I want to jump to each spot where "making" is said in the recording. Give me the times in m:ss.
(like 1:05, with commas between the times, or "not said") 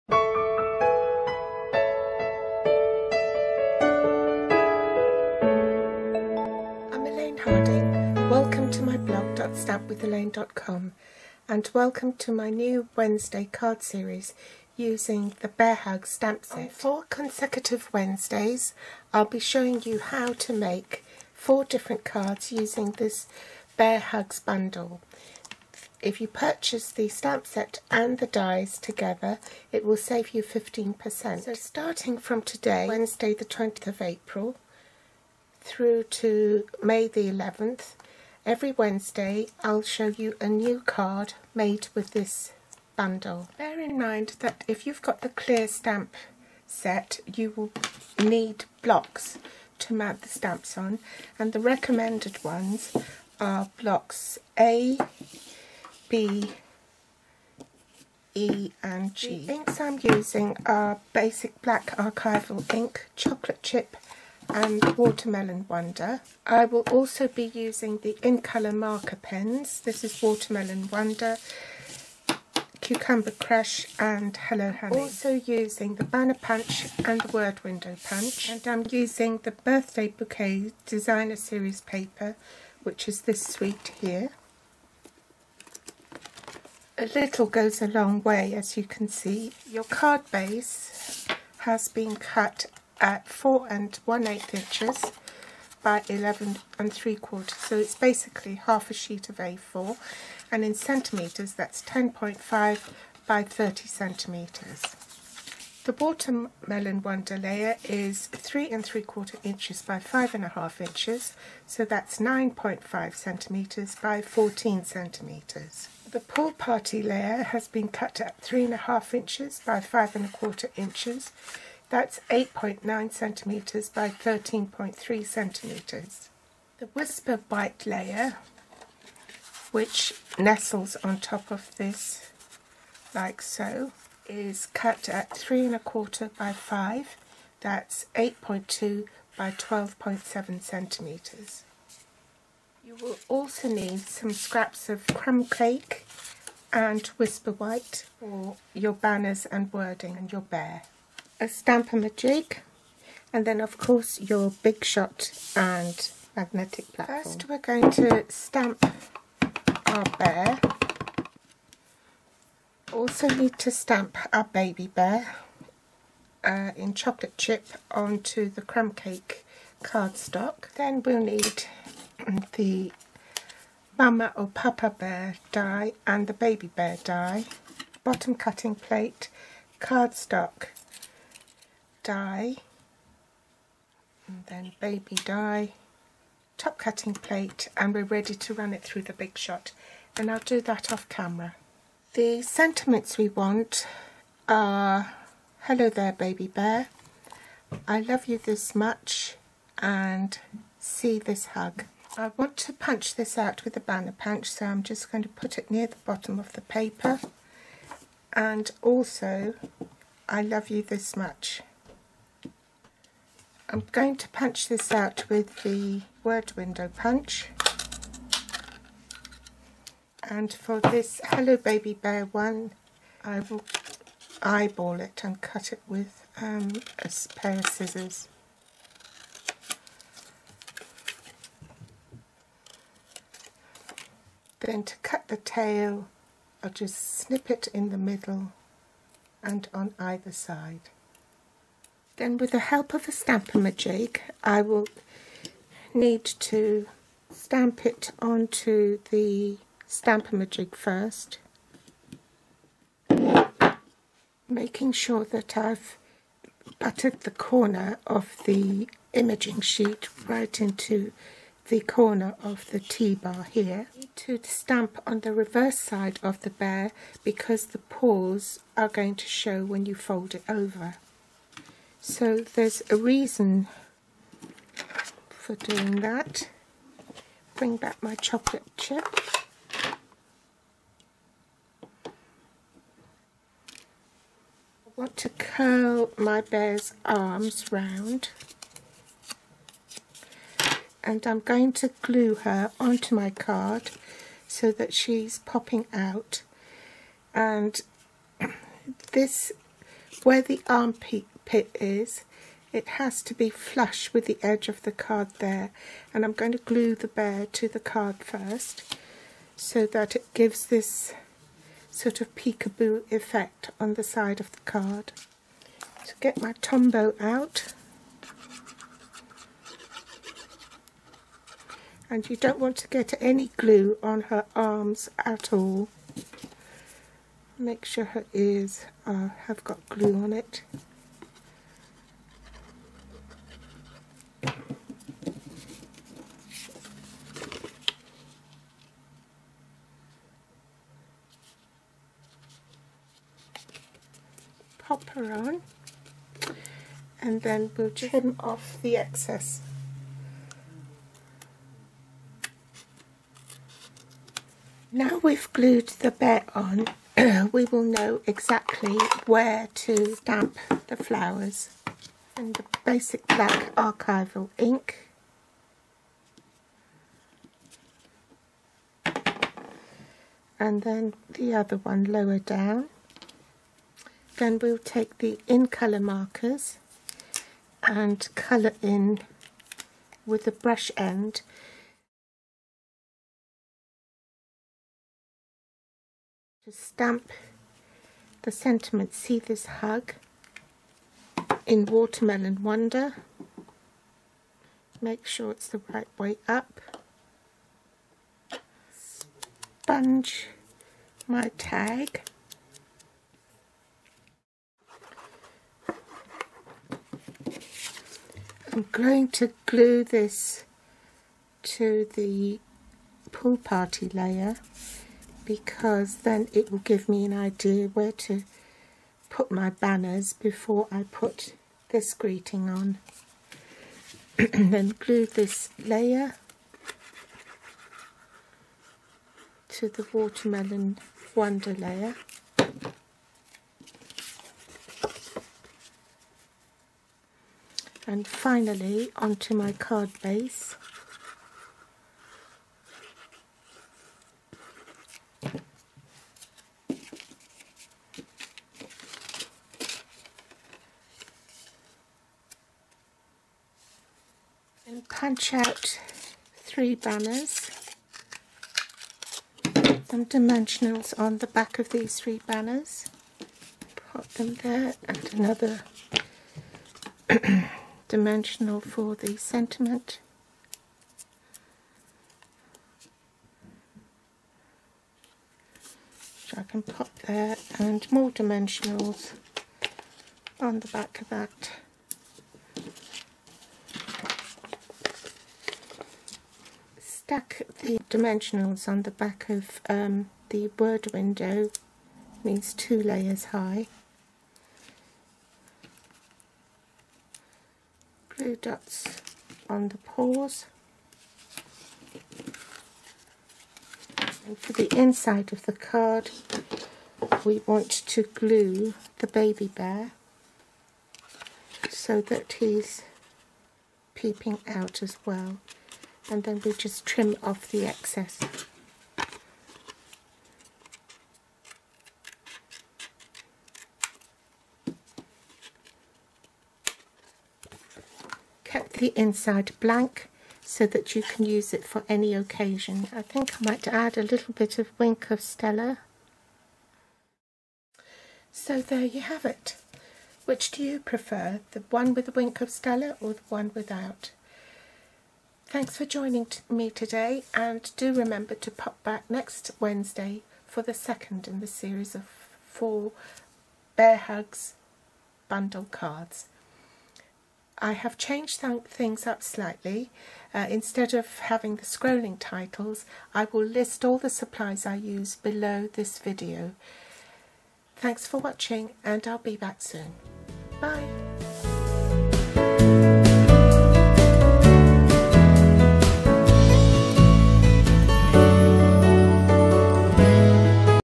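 4:14.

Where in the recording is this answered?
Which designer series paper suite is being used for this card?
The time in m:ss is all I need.
1:19.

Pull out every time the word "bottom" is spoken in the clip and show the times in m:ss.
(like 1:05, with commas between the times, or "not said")
2:58, 3:26.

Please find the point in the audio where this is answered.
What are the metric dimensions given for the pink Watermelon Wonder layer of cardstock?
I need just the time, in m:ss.
1:52.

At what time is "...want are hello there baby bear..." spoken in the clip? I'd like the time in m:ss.
3:13.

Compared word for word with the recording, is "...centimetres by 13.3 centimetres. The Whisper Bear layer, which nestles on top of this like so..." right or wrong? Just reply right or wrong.
wrong.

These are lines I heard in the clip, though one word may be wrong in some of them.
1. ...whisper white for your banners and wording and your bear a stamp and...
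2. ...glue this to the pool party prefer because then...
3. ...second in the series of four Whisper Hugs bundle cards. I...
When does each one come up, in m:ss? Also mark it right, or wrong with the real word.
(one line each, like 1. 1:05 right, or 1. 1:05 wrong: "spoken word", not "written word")
1. 2:27 right
2. 6:49 wrong: "layer", not "prefer"
3. 9:10 wrong: "Bear", not "Whisper".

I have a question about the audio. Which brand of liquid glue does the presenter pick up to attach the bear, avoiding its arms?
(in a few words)
Tombow.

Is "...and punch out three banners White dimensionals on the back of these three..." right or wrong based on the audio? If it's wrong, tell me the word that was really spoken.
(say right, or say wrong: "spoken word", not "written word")
wrong: "Some", not "White".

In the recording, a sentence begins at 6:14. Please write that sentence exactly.
Then we'll take the in colour markers and colour in with the brush end.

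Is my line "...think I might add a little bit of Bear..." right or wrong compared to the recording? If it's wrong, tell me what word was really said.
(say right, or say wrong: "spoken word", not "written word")
wrong: "Wink", not "Bear".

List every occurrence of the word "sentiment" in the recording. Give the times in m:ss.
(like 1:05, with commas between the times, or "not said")
3:12, 6:28, 7:49.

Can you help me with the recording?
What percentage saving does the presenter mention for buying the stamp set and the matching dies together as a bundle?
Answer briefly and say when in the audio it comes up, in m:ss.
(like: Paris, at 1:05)
15%, at 0:30.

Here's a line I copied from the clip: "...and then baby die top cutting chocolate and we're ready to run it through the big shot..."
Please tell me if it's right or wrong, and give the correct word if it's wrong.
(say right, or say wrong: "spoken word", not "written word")
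wrong: "plate", not "chocolate".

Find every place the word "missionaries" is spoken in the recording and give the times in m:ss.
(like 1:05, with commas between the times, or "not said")
not said.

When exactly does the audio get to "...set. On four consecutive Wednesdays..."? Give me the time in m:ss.
0:16.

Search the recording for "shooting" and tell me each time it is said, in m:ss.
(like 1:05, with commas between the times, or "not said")
not said.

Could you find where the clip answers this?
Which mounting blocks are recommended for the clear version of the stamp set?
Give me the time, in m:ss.
0:53.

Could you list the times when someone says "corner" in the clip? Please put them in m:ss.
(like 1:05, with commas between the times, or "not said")
4:17, 4:21.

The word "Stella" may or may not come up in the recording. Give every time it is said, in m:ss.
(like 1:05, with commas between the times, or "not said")
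8:55, 9:02.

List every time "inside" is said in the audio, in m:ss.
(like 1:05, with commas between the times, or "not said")
8:24, 8:49.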